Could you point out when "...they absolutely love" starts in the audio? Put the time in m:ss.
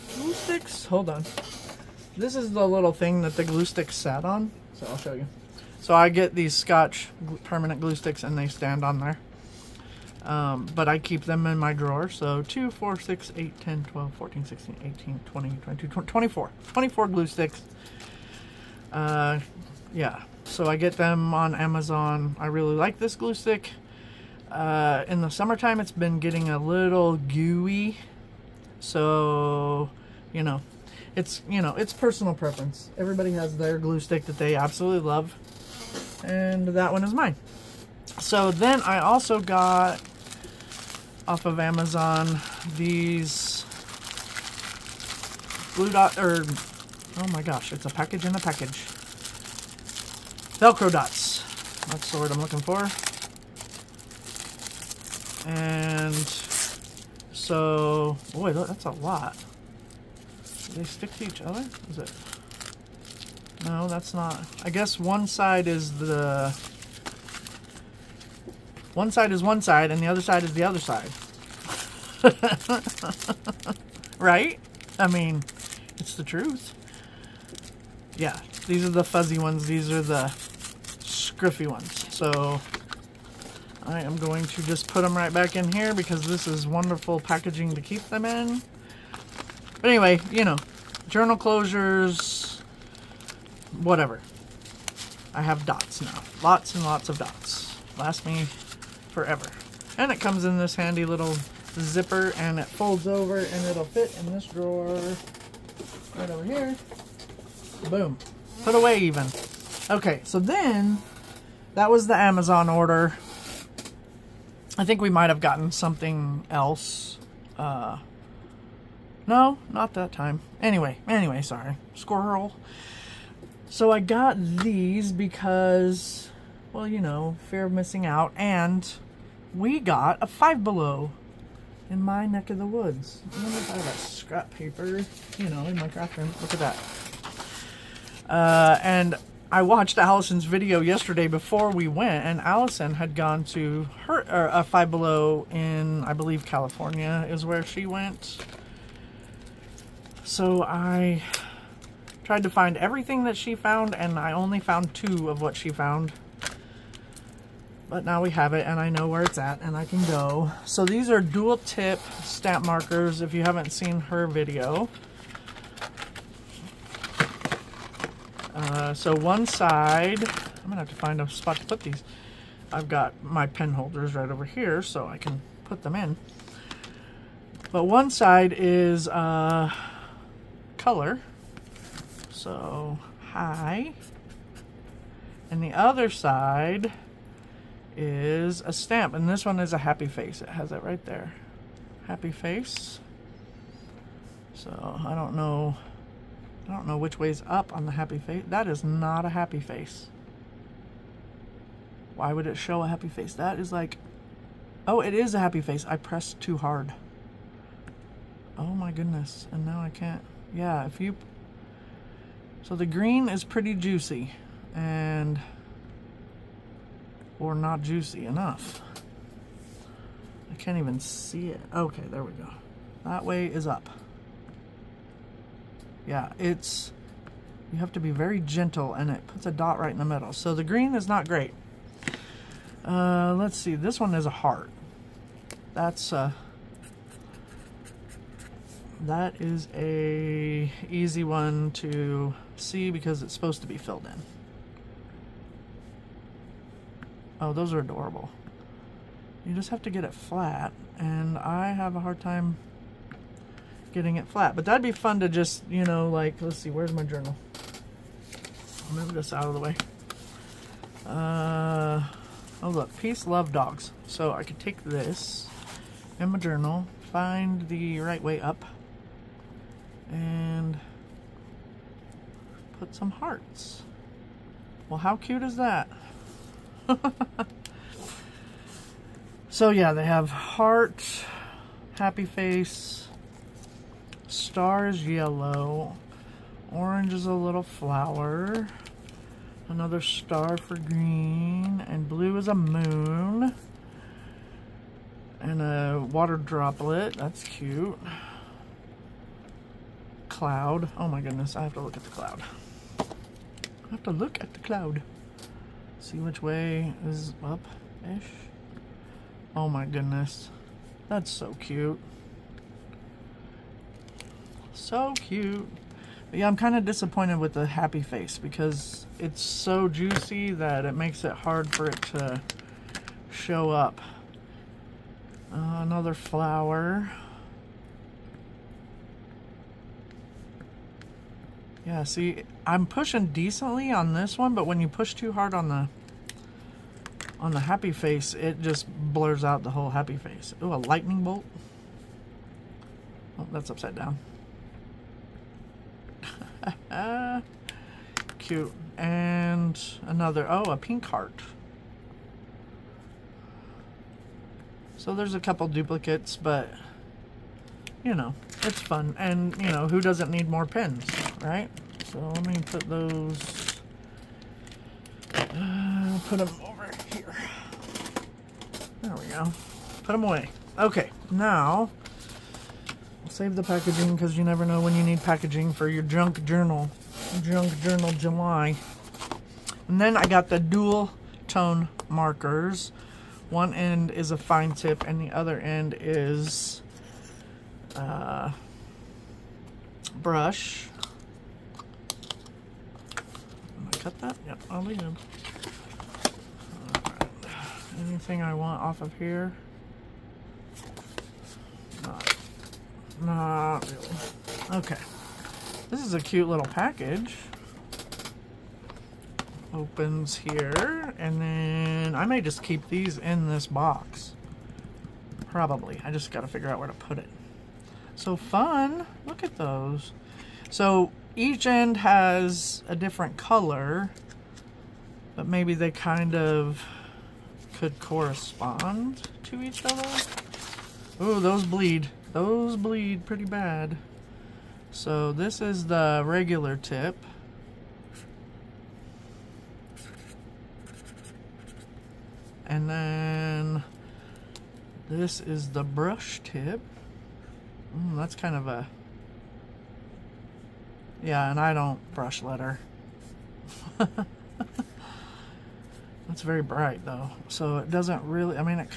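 0:34.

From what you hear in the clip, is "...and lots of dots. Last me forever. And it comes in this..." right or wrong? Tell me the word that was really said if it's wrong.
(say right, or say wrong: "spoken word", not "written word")
right.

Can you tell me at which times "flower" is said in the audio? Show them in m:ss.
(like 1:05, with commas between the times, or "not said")
4:47, 5:26.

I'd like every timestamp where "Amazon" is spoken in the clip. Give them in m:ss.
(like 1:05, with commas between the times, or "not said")
0:21, 0:41, 1:52.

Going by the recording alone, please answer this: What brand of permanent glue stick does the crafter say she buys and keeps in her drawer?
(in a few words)
Scotch.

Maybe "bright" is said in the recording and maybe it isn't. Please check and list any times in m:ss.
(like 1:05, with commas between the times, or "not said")
7:36.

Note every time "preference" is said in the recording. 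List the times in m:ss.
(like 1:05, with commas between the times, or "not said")
0:32.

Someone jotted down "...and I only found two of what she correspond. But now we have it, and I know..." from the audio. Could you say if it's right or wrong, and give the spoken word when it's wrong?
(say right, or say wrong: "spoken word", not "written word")
wrong: "found", not "correspond".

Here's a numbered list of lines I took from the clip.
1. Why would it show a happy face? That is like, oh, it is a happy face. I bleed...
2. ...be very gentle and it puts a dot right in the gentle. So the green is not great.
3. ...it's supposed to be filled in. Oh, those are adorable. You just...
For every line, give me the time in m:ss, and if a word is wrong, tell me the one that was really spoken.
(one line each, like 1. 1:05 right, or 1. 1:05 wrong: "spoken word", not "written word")
1. 3:22 wrong: "pressed", not "bleed"
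2. 3:48 wrong: "middle", not "gentle"
3. 4:03 right.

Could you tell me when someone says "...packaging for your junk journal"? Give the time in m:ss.
6:15.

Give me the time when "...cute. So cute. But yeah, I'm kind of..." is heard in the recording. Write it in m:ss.
5:11.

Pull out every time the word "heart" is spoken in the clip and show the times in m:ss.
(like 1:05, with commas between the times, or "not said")
3:54, 4:33, 4:40, 5:51.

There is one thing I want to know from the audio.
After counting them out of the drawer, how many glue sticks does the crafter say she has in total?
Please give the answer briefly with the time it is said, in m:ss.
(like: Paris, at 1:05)
24, at 0:16.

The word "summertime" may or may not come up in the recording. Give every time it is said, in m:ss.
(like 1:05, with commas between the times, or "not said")
0:25.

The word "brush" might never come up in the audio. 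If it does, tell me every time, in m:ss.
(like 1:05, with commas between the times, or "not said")
6:30, 7:25, 7:32.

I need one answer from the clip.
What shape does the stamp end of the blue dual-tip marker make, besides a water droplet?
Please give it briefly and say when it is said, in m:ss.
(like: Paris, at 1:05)
A moon, at 4:52.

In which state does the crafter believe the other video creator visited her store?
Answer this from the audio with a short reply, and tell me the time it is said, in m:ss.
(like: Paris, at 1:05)
California, at 2:26.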